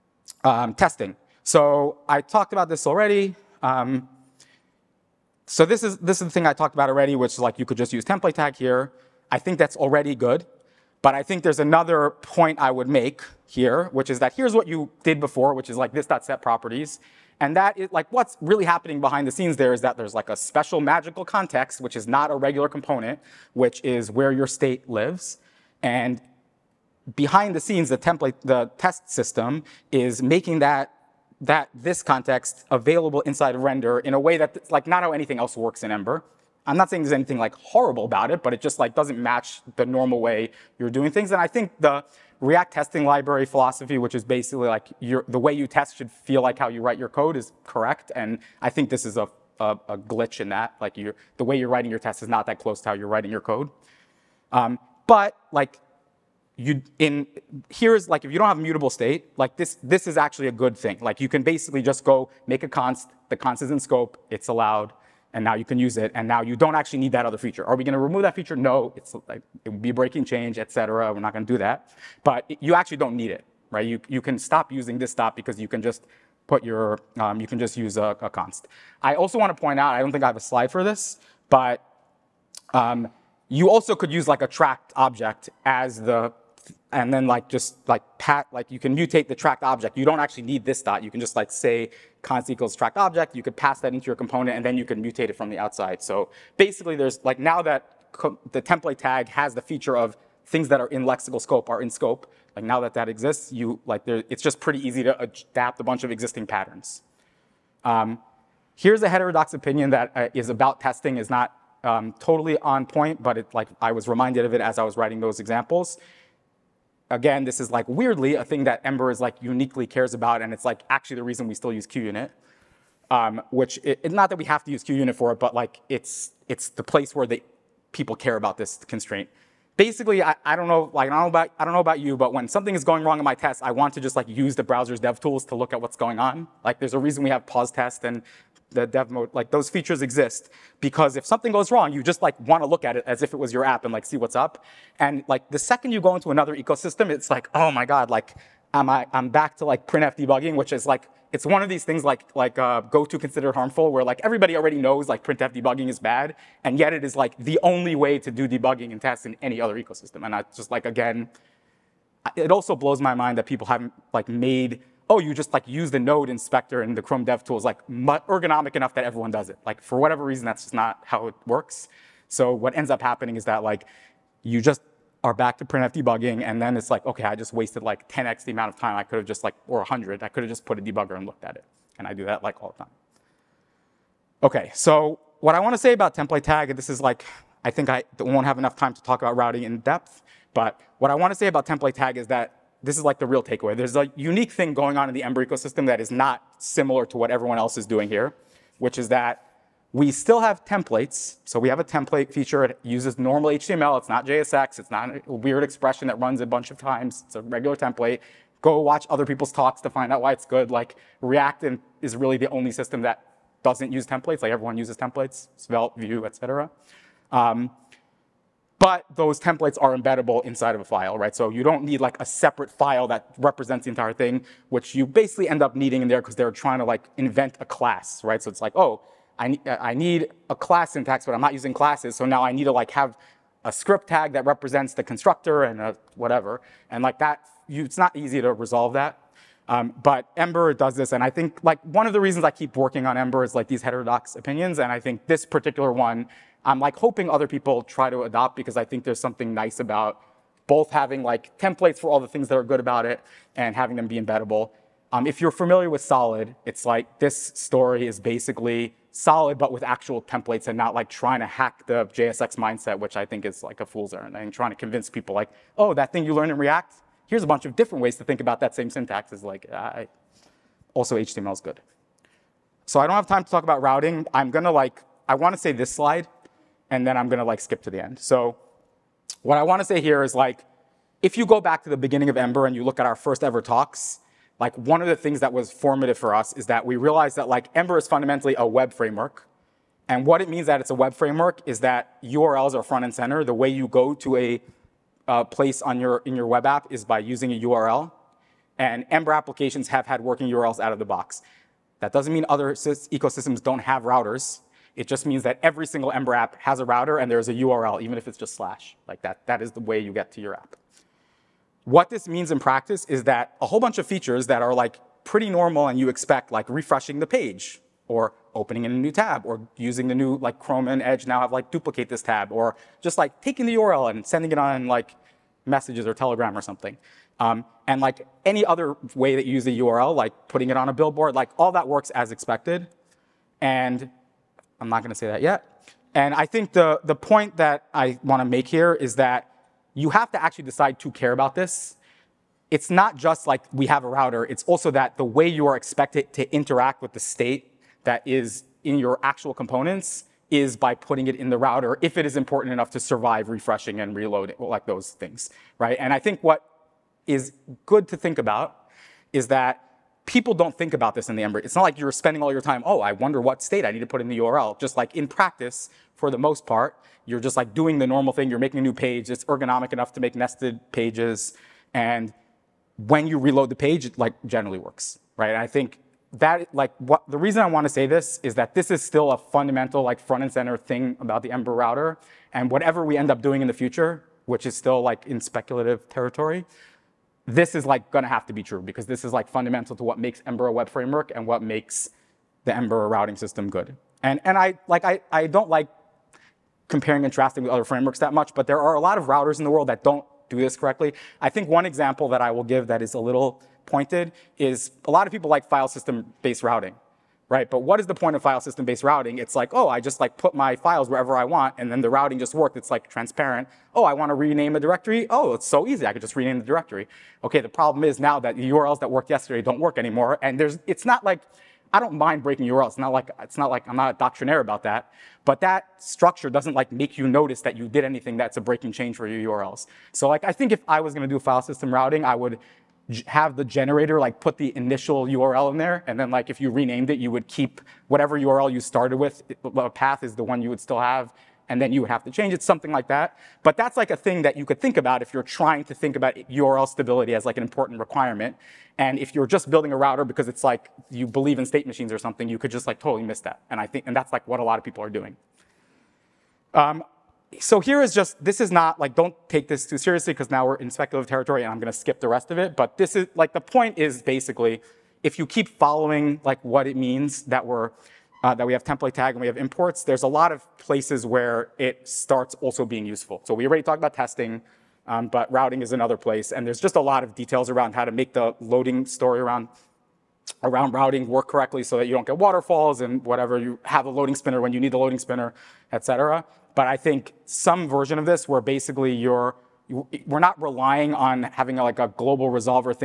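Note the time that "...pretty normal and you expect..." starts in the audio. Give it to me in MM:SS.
05:15.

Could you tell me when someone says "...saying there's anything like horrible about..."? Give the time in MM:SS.
00:36.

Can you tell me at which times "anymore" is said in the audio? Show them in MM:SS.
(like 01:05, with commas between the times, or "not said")
06:59.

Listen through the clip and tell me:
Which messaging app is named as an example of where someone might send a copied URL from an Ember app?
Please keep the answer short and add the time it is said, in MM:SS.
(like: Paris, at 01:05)
Telegram, at 05:26.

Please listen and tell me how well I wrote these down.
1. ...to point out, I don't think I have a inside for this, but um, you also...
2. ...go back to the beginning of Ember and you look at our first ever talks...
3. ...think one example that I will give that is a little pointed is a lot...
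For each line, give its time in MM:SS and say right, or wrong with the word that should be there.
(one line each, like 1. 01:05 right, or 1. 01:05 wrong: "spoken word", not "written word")
1. 01:19 wrong: "slide", not "inside"
2. 04:41 right
3. 06:41 right.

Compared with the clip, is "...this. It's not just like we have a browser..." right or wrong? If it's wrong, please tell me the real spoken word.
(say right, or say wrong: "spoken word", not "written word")
wrong: "router", not "browser".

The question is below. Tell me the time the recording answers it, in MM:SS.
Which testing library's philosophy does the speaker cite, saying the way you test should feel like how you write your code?
00:42.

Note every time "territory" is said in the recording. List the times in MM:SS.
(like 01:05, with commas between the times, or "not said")
06:26, 07:41.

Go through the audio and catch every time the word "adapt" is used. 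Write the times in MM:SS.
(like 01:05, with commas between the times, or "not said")
01:45.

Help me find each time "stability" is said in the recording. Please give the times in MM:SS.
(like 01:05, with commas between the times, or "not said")
07:26.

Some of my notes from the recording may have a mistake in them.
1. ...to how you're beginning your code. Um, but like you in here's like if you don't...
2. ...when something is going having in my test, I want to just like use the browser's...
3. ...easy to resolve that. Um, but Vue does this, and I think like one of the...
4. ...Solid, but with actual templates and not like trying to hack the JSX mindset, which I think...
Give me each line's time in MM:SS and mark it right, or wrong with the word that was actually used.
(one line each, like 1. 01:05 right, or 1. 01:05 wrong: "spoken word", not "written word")
1. 00:52 wrong: "writing", not "beginning"
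2. 02:12 wrong: "wrong", not "having"
3. 03:58 wrong: "Ember", not "Vue"
4. 04:19 right.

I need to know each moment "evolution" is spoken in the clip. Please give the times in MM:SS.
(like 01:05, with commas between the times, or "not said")
not said.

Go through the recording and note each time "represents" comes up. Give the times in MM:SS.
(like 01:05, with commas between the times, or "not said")
03:43, 03:54.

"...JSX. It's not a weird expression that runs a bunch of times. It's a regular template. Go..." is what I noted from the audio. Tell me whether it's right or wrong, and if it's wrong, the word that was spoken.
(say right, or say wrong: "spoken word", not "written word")
right.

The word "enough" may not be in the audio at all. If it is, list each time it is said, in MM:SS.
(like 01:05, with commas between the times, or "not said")
02:48, 03:08, 05:52, 06:09.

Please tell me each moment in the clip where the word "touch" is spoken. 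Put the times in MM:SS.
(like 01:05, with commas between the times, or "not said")
not said.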